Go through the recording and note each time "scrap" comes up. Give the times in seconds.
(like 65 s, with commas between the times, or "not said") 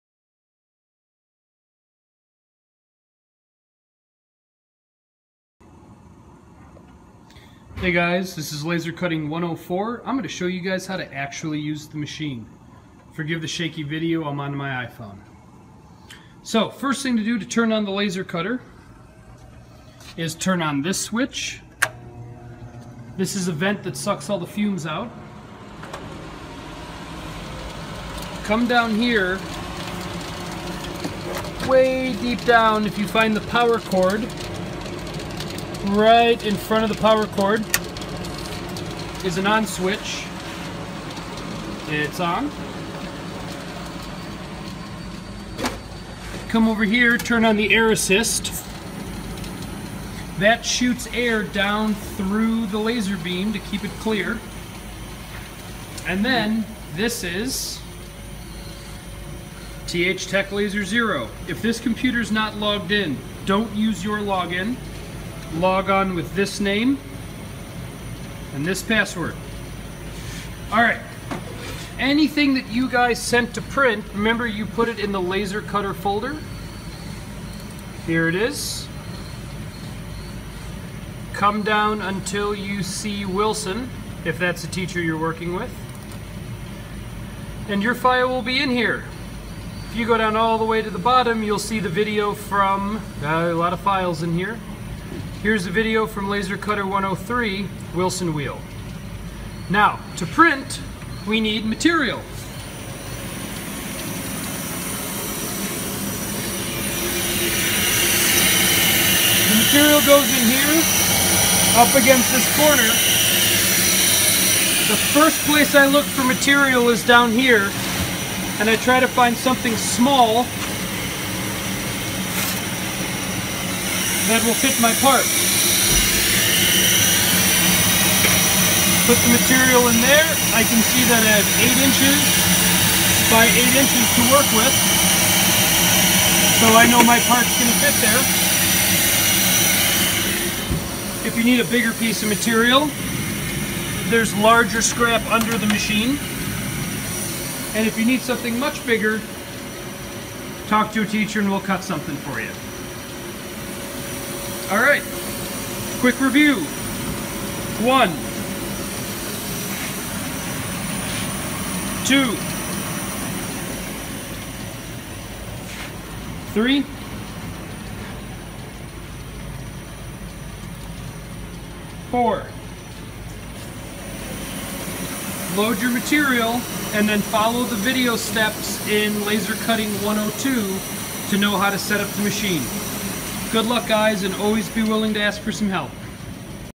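144 s.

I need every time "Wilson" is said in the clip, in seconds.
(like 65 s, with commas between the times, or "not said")
83 s, 97 s.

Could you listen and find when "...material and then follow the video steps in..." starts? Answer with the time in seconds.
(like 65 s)
175 s.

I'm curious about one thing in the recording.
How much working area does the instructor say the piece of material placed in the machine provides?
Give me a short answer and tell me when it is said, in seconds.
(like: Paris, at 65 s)
8 inches by 8 inches, at 131 s.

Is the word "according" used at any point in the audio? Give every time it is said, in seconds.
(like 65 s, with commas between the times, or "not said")
not said.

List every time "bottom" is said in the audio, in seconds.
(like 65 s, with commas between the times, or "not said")
90 s.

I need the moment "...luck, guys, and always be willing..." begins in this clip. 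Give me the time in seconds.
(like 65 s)
183 s.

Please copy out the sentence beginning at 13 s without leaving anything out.
Forgive the shaky video, I'm on my iPhone.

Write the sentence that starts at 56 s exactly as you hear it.
And then this is TH Tech Laser Zero.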